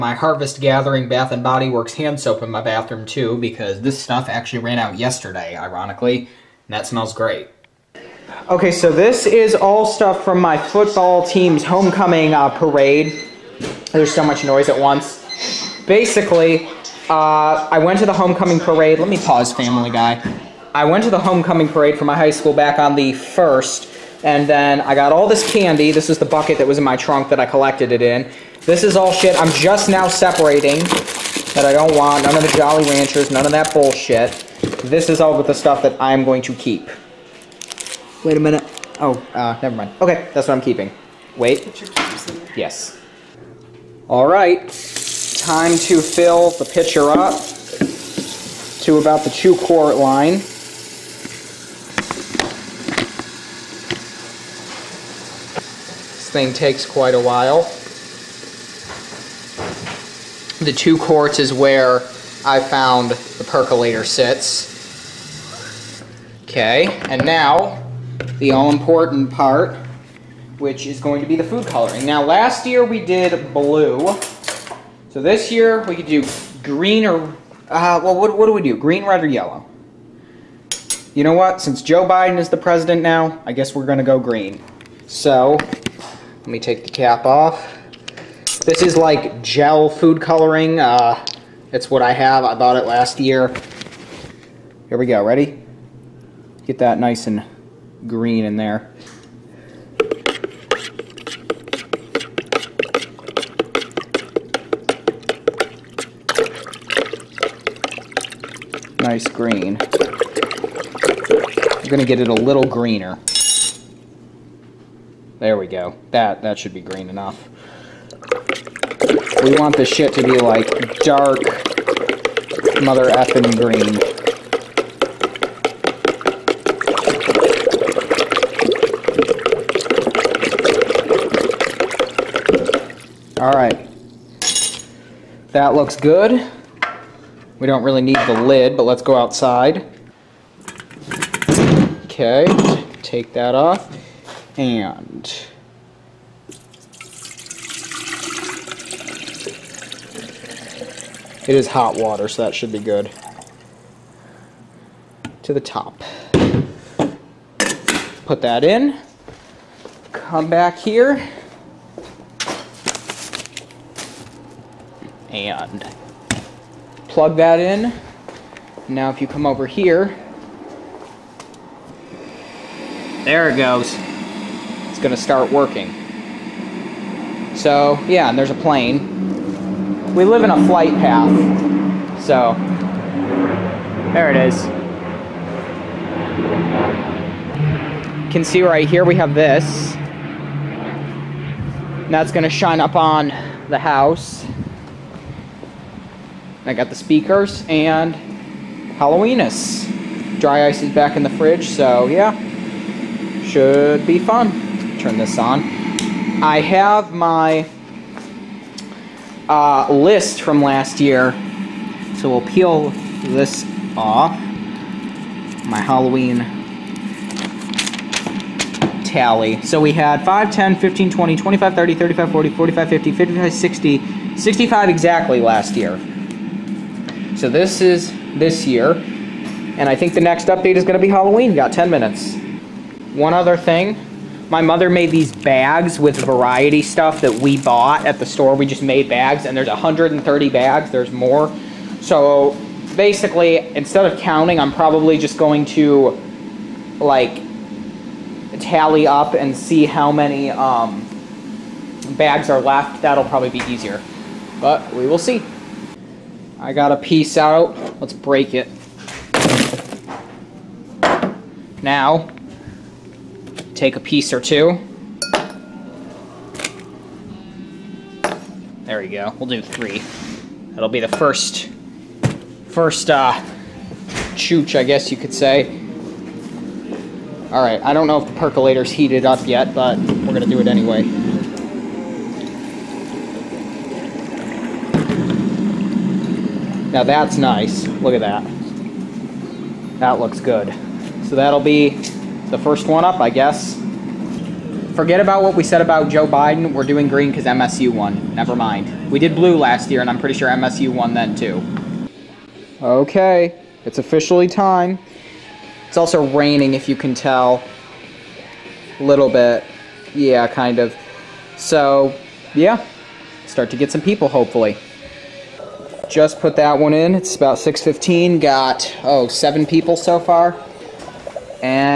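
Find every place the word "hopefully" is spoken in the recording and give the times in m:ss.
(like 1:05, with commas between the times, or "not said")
5:14.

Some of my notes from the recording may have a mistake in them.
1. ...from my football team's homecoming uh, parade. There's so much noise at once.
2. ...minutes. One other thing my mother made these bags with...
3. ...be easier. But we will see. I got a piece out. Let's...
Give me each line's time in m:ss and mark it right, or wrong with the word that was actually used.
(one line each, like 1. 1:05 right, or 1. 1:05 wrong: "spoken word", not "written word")
1. 0:10 right
2. 3:51 right
3. 4:13 right.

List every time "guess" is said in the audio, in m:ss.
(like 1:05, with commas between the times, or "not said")
1:23, 4:34, 4:53.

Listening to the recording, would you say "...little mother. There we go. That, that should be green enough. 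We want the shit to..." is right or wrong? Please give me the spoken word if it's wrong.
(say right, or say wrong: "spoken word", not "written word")
wrong: "greener", not "mother".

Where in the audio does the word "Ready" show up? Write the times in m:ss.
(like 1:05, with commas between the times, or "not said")
1:35.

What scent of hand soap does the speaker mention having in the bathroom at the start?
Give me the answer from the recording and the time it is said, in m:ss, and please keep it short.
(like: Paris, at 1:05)
Harvest Gathering, at 0:00.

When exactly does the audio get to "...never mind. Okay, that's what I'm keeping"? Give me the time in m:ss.
0:39.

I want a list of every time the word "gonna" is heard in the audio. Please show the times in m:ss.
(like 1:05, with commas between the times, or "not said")
2:54, 4:40.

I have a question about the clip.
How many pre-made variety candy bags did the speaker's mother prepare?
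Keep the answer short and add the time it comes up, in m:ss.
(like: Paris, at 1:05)
130, at 3:59.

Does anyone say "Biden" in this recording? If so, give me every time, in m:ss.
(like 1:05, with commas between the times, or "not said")
1:22, 4:56.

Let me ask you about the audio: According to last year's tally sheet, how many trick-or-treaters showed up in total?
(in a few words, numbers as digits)
65.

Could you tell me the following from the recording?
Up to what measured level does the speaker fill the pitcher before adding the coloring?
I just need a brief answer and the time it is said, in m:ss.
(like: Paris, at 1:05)
two quart line, at 0:49.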